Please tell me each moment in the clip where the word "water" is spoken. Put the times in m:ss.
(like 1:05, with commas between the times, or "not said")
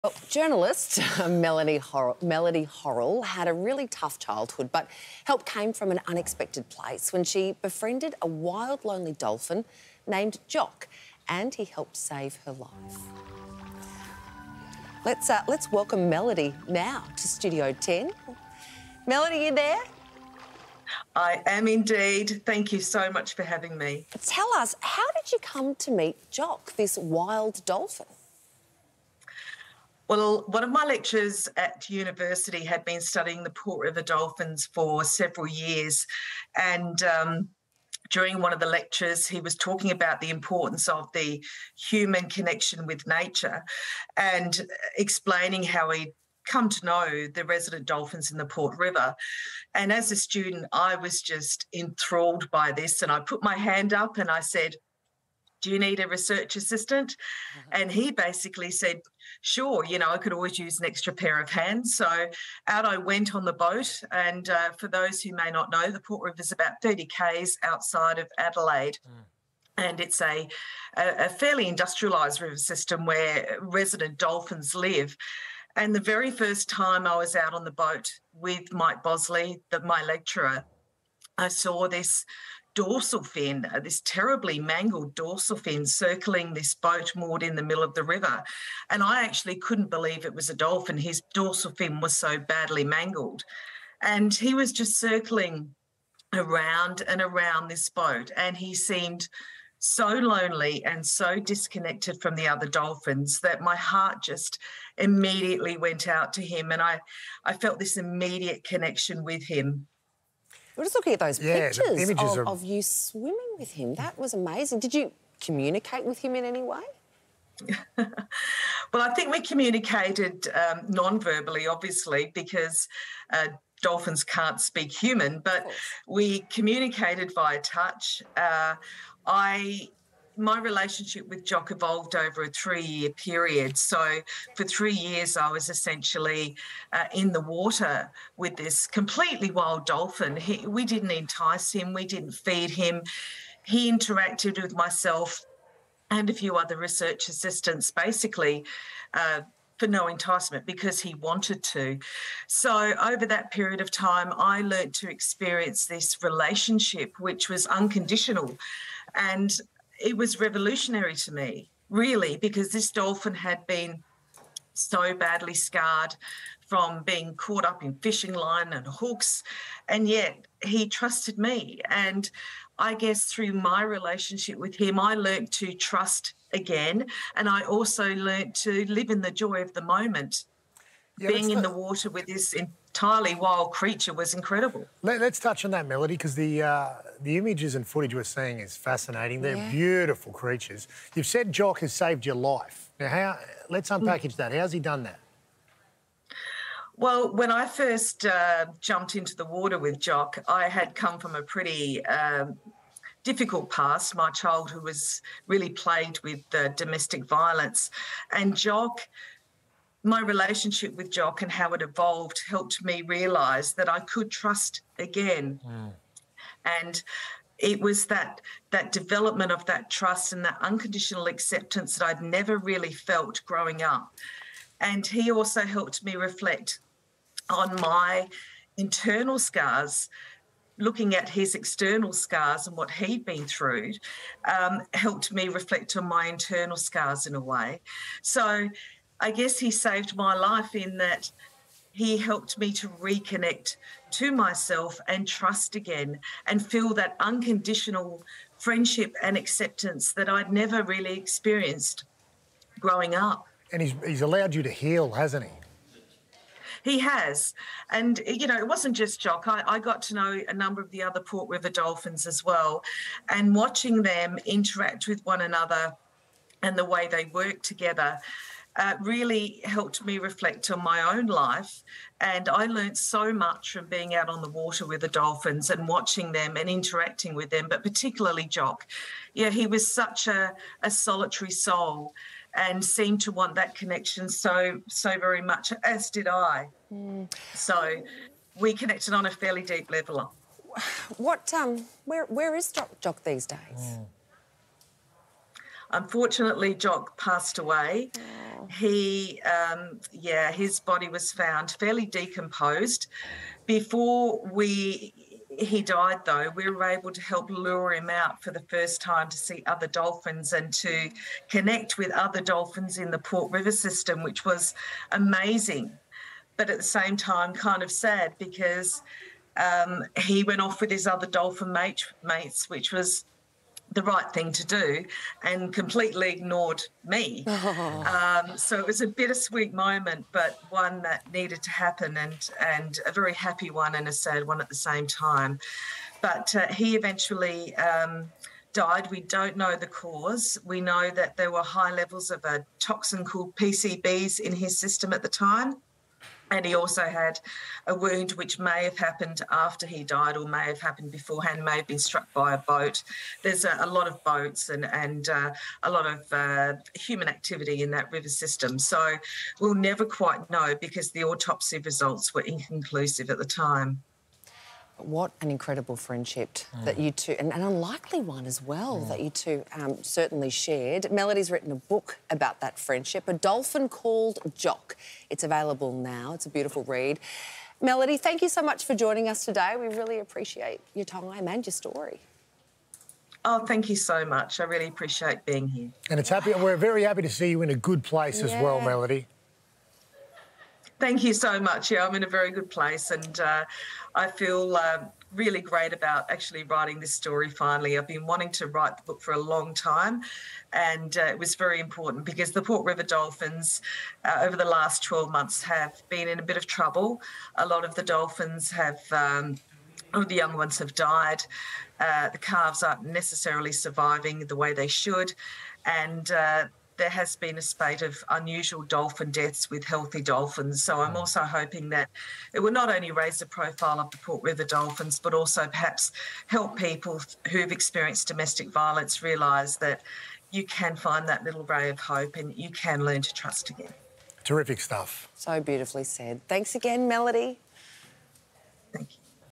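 2:17, 3:01, 3:19, 4:34.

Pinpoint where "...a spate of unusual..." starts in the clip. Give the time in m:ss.
6:57.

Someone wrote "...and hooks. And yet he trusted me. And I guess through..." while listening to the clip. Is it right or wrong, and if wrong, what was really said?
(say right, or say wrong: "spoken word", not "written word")
right.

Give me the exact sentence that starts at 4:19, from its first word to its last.
I, I, got to know a number of the other Port River Dolphins as well.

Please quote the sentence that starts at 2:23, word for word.
He interacted with myself and a few other research assistants basically.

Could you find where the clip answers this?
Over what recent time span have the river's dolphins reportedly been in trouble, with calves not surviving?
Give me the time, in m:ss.
6:45.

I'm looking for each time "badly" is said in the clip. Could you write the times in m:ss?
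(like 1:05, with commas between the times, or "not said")
1:32, 2:45.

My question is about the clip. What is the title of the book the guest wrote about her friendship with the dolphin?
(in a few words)
A Dolphin Called Jock.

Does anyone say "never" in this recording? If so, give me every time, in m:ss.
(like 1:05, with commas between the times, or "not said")
3:42, 4:10, 5:59.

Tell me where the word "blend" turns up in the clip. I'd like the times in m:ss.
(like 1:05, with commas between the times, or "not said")
not said.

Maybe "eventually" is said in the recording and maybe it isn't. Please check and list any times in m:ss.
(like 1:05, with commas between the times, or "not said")
5:36.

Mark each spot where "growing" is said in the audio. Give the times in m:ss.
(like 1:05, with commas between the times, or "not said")
3:43, 4:12.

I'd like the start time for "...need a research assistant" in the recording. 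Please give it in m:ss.
0:55.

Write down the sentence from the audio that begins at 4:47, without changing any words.
so we connected on a fairly deep level what um where where is jock, jock these days mm.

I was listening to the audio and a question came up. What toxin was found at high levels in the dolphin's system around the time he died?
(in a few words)
PCBs.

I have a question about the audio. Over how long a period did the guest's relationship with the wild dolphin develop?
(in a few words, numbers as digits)
3 years.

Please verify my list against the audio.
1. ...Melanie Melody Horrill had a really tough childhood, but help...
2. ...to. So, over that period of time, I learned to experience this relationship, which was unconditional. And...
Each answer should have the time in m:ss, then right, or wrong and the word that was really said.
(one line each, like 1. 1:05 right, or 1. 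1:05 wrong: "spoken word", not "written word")
1. 0:01 right
2. 2:31 right.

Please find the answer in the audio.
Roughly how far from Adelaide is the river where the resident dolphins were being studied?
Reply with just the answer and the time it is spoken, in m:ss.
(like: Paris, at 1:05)
30 km, at 1:06.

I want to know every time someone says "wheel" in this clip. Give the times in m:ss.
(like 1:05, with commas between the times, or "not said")
not said.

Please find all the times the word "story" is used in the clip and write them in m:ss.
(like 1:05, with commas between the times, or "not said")
6:21, 6:37.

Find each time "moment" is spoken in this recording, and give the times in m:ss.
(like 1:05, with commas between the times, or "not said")
2:59, 5:29.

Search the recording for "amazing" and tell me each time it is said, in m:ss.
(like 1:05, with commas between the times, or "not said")
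1:54, 5:15.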